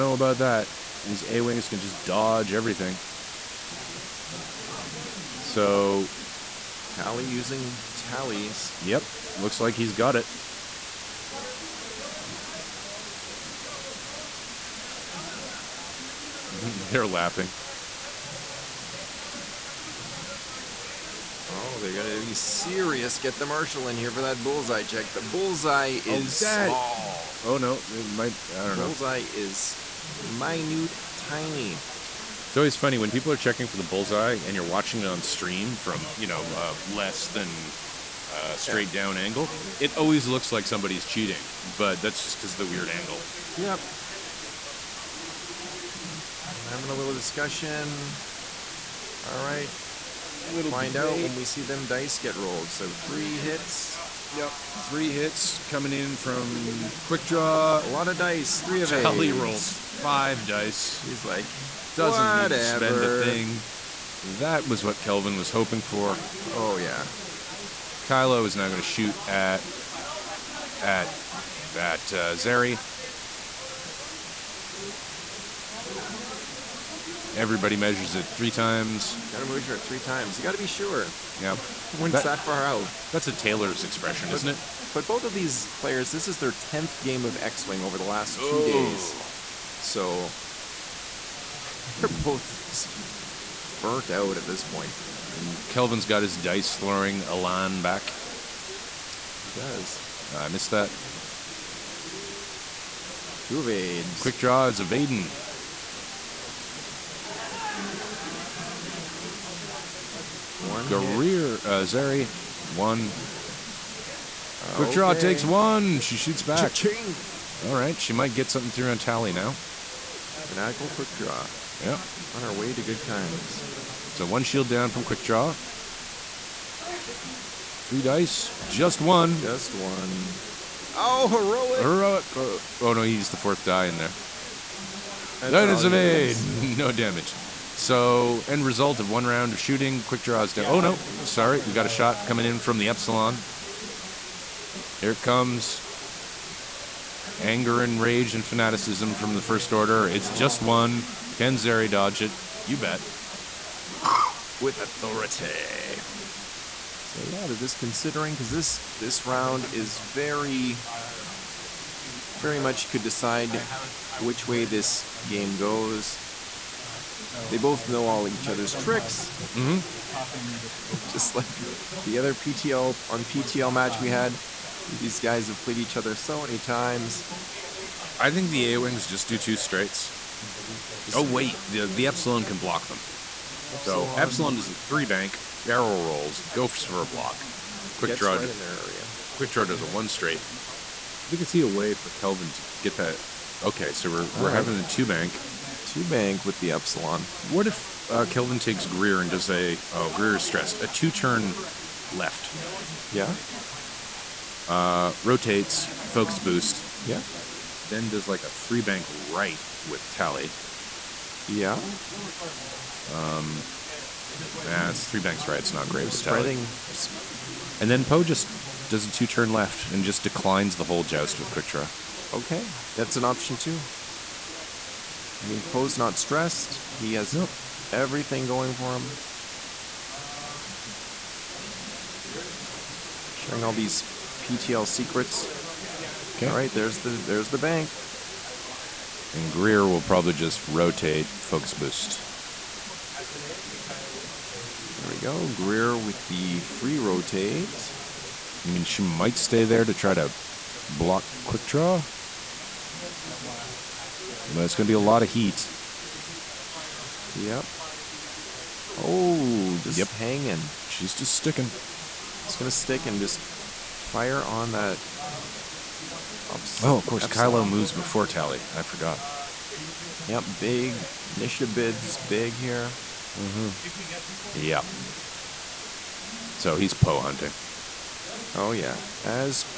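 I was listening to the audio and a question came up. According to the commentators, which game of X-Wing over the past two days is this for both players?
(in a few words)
10th.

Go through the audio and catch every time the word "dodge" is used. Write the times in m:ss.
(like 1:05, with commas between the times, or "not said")
0:02, 2:31.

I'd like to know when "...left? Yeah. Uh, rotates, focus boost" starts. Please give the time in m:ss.
3:22.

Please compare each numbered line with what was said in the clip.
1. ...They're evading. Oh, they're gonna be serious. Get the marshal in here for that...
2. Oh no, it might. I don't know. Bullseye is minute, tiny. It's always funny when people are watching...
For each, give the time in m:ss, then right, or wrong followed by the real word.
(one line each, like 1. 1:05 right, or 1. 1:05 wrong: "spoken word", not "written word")
1. 0:16 wrong: "laughing", not "evading"
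2. 0:27 wrong: "checking", not "watching".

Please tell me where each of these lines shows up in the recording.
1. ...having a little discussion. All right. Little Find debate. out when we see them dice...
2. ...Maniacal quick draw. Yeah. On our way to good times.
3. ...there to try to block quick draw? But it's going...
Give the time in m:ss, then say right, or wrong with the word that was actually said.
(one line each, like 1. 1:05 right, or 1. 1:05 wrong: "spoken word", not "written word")
1. 0:46 right
2. 2:00 right
3. 4:09 right.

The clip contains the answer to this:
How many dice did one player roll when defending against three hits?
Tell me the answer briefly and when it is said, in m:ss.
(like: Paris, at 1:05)
5, at 0:59.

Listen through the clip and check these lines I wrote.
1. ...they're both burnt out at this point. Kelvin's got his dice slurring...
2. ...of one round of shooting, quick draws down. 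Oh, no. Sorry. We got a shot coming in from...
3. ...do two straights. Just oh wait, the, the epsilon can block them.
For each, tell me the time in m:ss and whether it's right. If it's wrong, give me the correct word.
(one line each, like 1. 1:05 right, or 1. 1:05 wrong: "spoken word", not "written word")
1. 1:31 right
2. 2:18 right
3. 2:59 right.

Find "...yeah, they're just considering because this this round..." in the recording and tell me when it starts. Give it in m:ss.
2:37.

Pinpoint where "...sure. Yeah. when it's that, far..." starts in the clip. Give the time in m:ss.
1:20.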